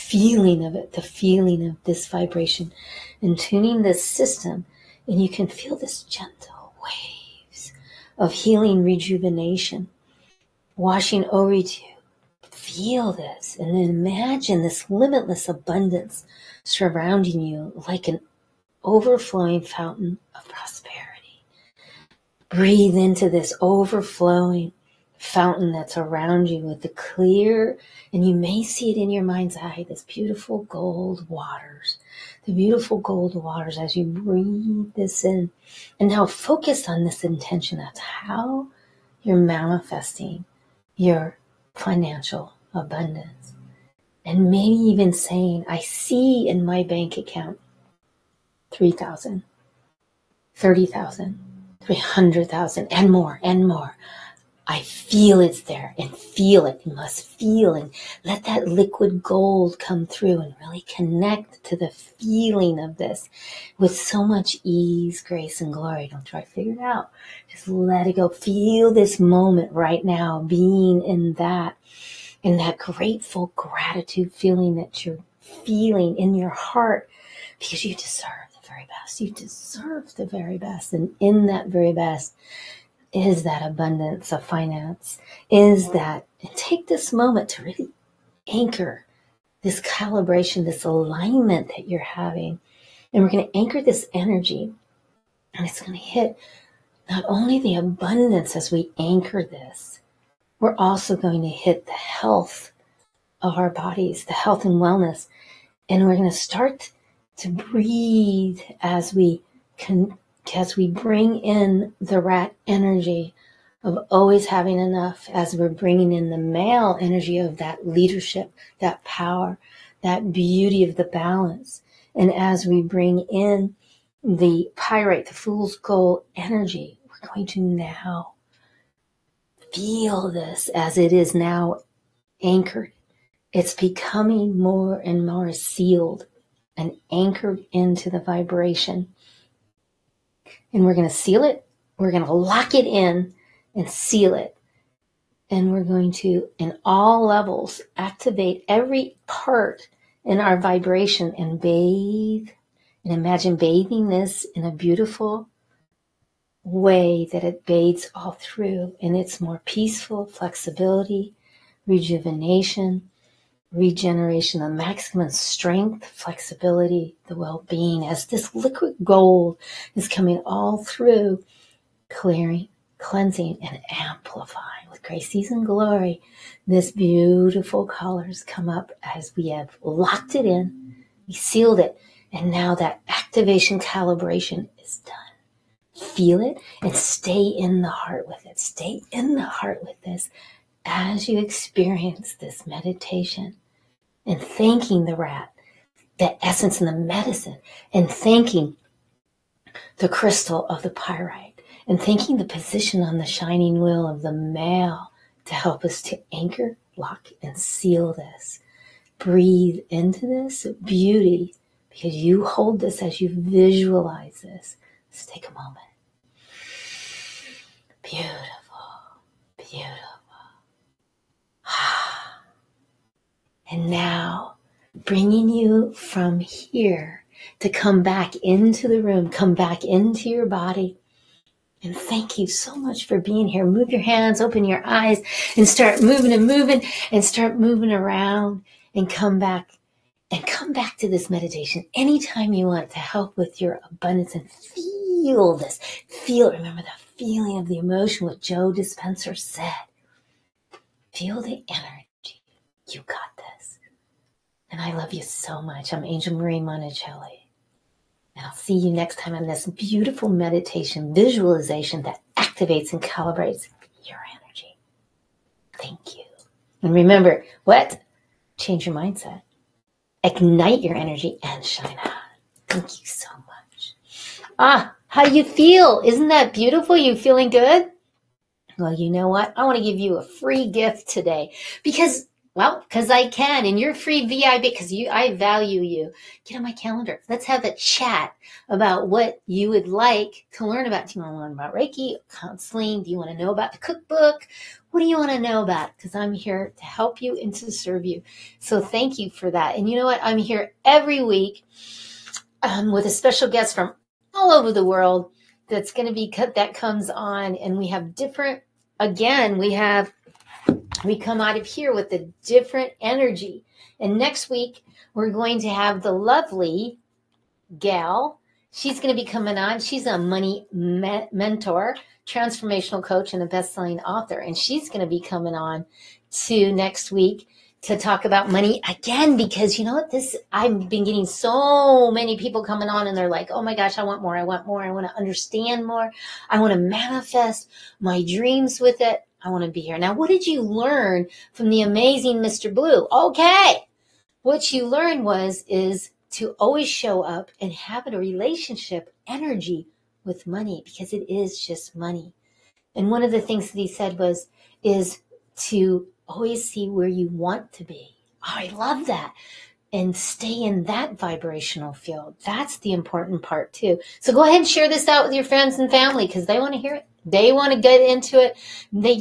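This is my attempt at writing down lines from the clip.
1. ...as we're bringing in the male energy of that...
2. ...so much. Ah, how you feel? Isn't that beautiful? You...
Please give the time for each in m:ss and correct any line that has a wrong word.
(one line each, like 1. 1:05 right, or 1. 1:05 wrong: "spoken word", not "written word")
1. 1:55 right
2. 4:33 right.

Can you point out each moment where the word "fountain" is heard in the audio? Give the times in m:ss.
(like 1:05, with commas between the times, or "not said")
0:19, 0:25.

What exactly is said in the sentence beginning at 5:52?
And one of the things that he said was is to always see where you want to be.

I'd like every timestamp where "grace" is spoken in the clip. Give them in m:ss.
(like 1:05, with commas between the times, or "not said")
1:05, 2:55.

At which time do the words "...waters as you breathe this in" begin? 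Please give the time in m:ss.
0:33.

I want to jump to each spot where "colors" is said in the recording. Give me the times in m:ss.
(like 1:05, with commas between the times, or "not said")
2:57.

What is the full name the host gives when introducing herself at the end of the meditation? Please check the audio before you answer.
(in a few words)
Angel Marie Monticelli.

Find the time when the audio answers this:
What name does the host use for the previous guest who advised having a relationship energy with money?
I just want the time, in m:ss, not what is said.
5:42.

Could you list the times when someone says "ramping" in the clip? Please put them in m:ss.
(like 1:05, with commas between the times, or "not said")
not said.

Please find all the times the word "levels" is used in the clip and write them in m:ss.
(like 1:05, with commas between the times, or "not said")
2:27.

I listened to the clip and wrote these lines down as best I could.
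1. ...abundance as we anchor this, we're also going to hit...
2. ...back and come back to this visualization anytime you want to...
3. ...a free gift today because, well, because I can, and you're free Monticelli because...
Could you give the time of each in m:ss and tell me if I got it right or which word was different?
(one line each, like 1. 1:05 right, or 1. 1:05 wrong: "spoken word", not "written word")
1. 1:37 right
2. 3:59 wrong: "meditation", not "visualization"
3. 4:40 wrong: "VIP", not "Monticelli".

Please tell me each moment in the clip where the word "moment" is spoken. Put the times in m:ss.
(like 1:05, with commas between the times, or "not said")
1:09, 1:27, 3:35.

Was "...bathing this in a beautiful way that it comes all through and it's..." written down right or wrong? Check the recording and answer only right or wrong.
wrong.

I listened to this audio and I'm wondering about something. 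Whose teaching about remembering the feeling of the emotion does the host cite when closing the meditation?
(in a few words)
Joe Dispenza.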